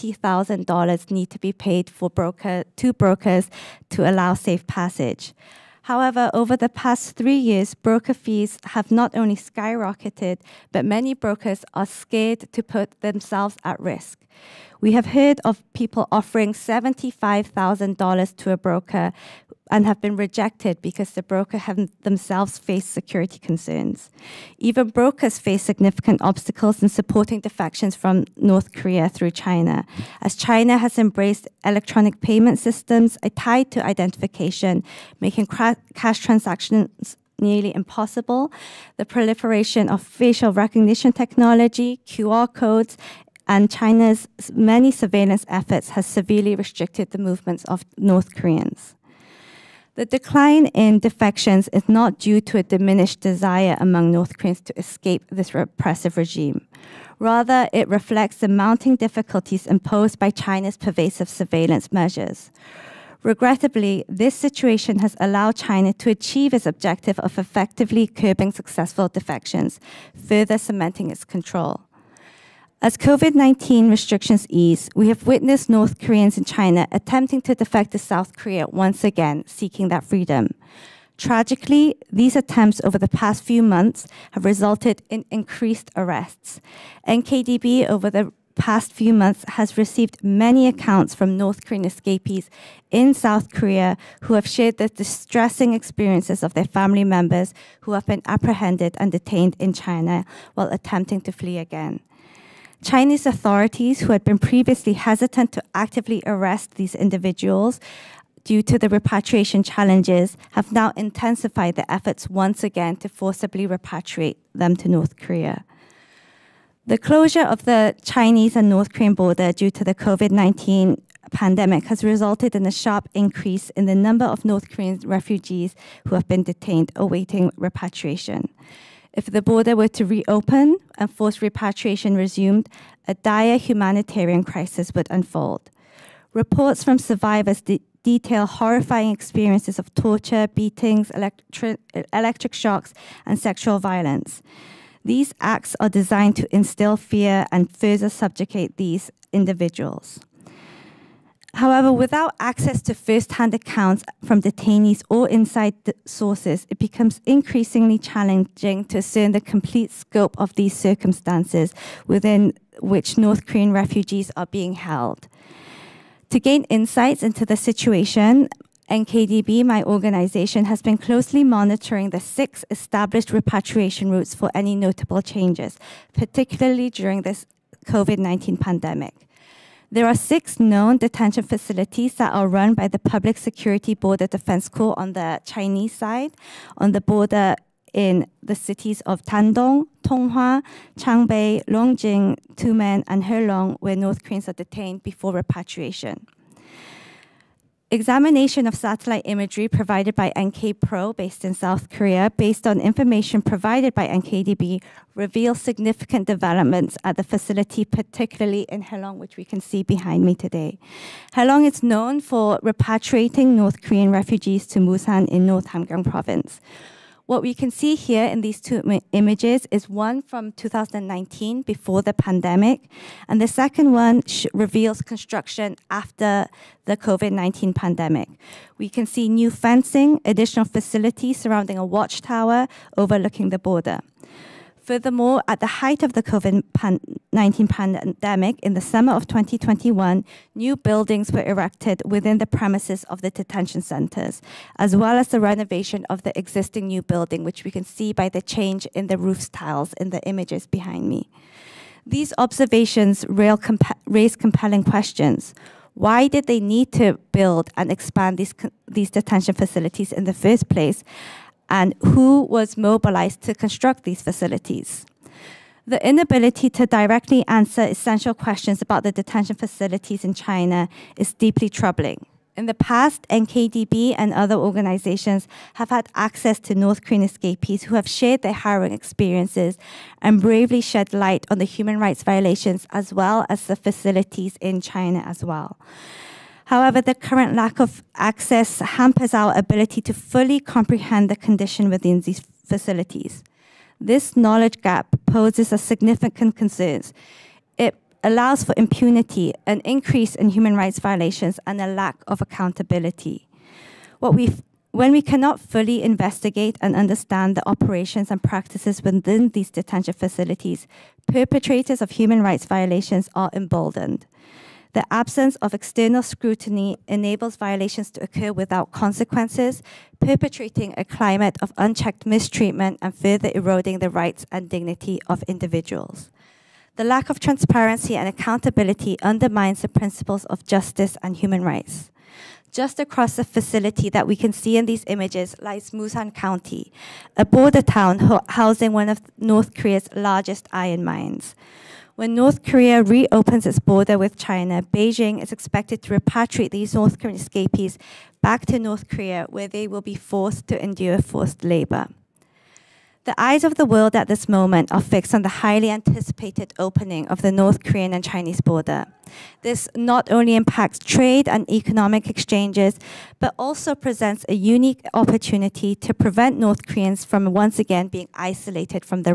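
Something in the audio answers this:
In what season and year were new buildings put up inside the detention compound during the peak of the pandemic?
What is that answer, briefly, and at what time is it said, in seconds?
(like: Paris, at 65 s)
summer of 2021, at 238 s.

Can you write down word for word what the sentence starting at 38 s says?
The proliferation of facial recognition technology, QR codes, and China's many surveillance efforts has severely restricted the movements of North Koreans.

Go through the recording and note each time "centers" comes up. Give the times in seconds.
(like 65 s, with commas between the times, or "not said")
243 s.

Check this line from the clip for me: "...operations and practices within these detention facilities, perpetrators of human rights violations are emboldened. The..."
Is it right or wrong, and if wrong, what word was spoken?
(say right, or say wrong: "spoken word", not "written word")
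right.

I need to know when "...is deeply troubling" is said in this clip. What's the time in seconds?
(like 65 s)
271 s.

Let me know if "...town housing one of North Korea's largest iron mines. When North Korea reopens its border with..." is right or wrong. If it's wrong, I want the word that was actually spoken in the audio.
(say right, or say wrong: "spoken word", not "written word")
right.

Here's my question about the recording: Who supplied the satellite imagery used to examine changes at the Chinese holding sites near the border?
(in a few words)
NK Pro.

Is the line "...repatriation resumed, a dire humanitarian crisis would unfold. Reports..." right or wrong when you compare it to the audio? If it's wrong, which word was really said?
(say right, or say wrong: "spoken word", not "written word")
right.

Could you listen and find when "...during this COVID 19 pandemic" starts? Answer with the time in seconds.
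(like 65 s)
176 s.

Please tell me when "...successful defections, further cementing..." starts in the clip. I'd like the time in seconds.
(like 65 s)
68 s.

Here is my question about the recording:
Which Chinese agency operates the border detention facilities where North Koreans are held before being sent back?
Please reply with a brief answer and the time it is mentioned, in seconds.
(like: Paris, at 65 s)
Public Security Border Defense Corps, at 182 s.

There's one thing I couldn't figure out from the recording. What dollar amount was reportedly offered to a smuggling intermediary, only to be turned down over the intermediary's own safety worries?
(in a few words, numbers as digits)
$75,000.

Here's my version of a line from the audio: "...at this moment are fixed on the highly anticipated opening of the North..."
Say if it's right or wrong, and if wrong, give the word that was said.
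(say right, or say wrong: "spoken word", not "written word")
right.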